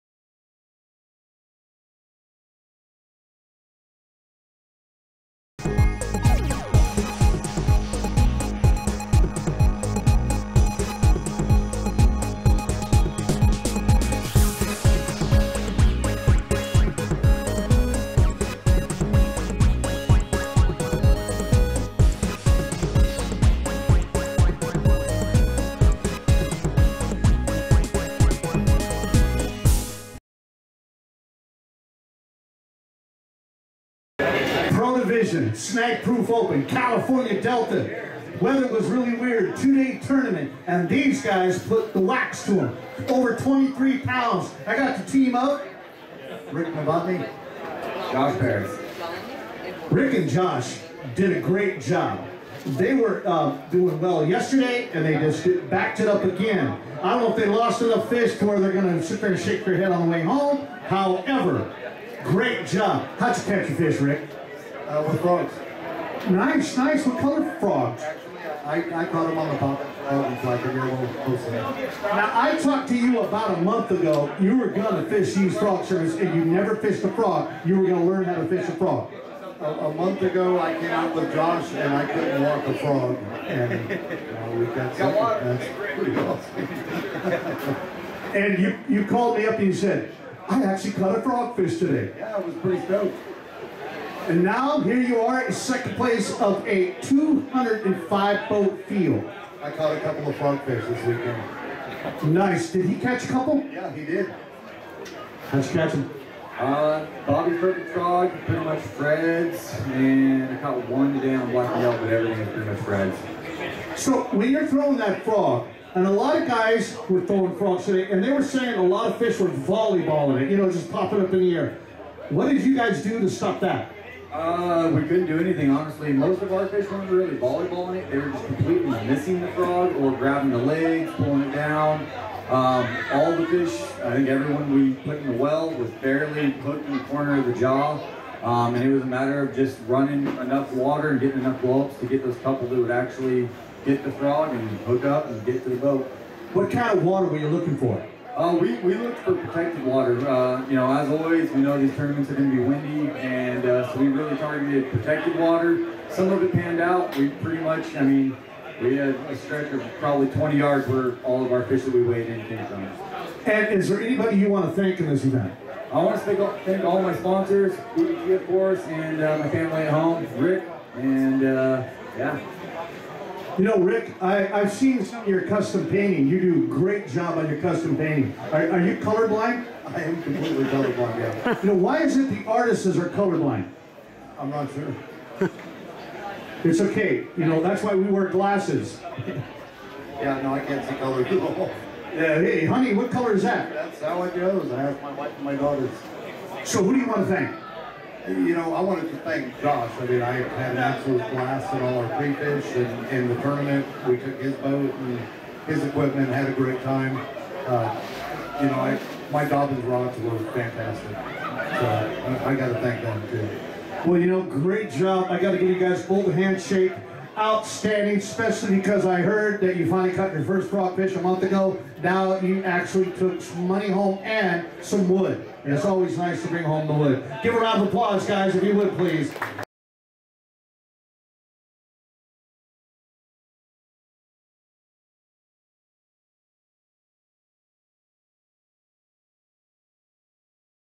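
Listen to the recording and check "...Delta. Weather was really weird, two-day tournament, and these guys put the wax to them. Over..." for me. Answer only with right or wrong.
right.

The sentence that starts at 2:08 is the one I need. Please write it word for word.
They were just completely missing the frog or grabbing the legs, pulling it down.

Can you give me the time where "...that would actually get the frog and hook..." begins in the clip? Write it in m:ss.
2:22.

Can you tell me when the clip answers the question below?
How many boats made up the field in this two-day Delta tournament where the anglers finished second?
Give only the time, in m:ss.
1:37.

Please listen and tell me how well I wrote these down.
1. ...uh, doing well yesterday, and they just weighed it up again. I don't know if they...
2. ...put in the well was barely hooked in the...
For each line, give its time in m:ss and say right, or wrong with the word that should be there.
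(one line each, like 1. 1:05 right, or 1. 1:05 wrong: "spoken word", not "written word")
1. 0:53 wrong: "backed", not "weighed"
2. 2:15 right.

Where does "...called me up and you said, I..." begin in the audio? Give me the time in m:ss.
1:29.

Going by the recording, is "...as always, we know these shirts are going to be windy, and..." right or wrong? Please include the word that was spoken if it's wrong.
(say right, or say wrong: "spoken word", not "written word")
wrong: "tournaments", not "shirts".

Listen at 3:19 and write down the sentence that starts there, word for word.
I mean, I had an absolute blast in all our pre-fish and in the tournament.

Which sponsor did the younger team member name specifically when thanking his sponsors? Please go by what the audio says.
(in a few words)
BBG.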